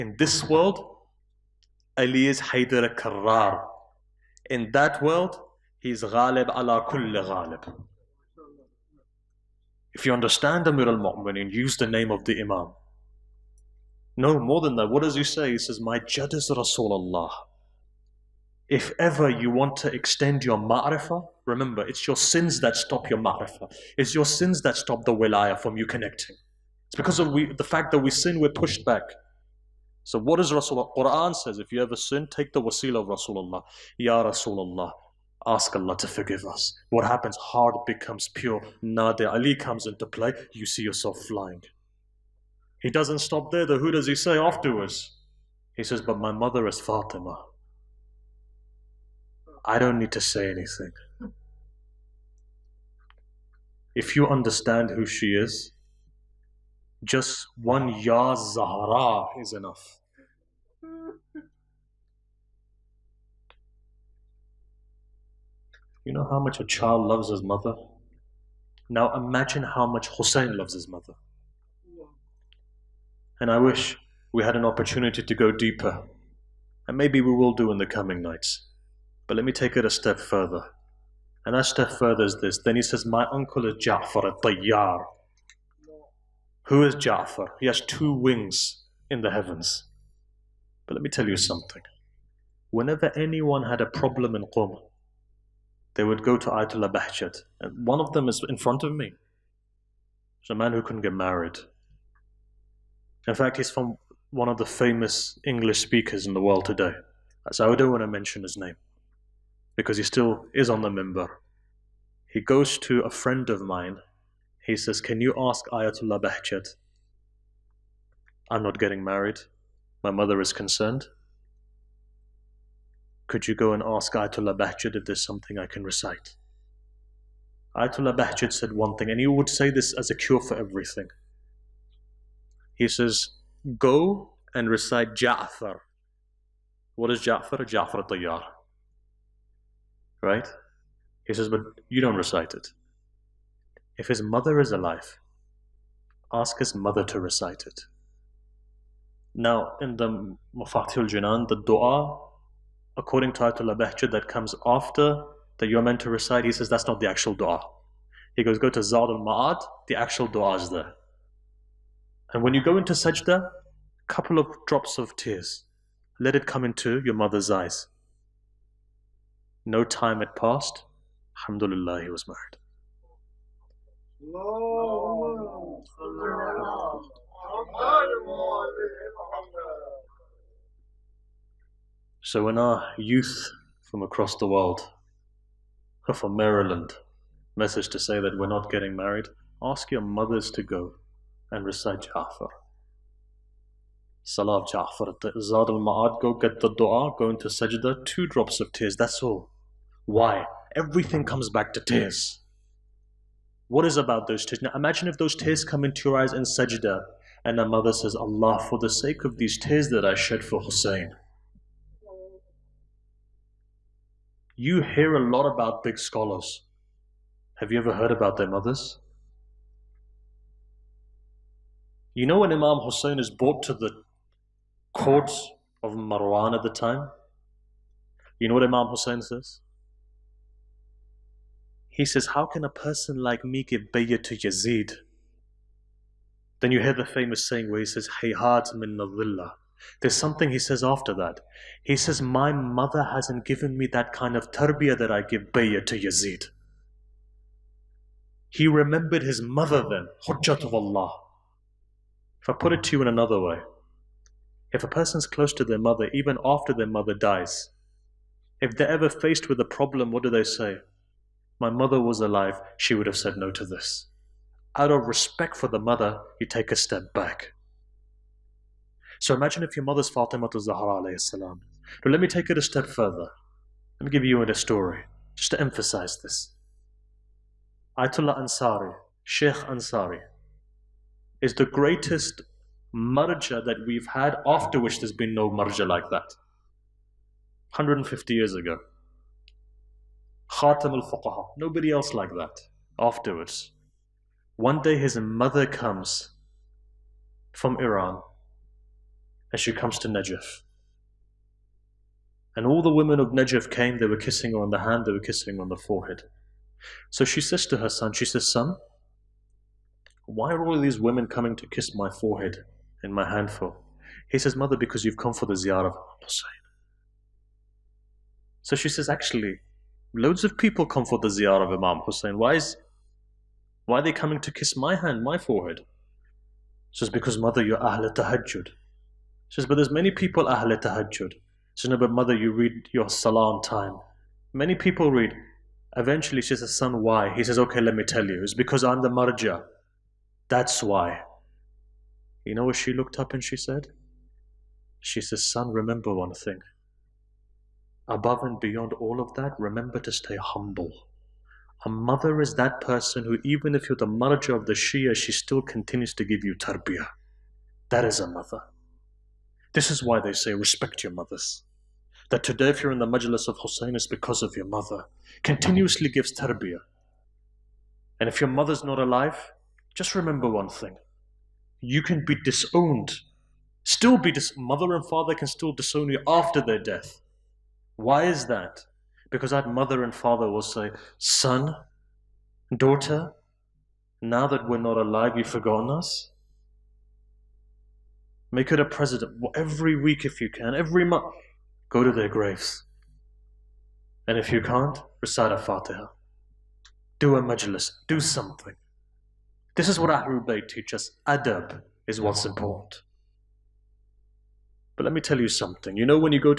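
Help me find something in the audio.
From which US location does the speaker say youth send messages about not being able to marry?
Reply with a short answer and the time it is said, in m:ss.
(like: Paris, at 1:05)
Maryland, at 3:06.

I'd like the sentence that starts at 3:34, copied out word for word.
You hear a lot about big scholars.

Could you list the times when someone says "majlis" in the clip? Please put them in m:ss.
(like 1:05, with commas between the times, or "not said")
6:03, 6:37.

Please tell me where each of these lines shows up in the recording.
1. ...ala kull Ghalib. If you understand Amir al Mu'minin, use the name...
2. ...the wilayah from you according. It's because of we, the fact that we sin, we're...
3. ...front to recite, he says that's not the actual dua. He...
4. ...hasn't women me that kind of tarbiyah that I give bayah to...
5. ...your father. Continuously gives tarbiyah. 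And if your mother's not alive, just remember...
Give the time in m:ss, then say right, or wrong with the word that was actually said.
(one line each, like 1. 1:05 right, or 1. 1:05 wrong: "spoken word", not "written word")
1. 0:06 right
2. 0:25 wrong: "connecting", not "according"
3. 2:35 wrong: "meant", not "front"
4. 4:03 wrong: "given", not "women"
5. 6:04 wrong: "mother", not "father".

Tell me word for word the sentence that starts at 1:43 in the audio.
In fact, he's from one of the famous English speakers in the world today.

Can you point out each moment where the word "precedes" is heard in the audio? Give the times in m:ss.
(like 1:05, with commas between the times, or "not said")
not said.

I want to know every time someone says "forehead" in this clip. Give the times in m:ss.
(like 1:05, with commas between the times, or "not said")
5:05, 5:12, 5:25.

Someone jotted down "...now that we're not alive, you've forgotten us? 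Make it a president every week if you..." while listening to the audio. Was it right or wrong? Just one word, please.
right.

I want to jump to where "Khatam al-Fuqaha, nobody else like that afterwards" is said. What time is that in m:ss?
4:50.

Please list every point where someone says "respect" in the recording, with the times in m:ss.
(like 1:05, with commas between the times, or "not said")
4:25, 6:00.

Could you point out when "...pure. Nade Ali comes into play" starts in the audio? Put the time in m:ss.
0:38.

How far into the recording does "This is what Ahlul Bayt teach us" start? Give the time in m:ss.
6:39.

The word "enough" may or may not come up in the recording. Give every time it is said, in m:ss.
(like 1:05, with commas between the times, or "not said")
0:59.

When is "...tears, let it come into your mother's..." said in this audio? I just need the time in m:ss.
2:45.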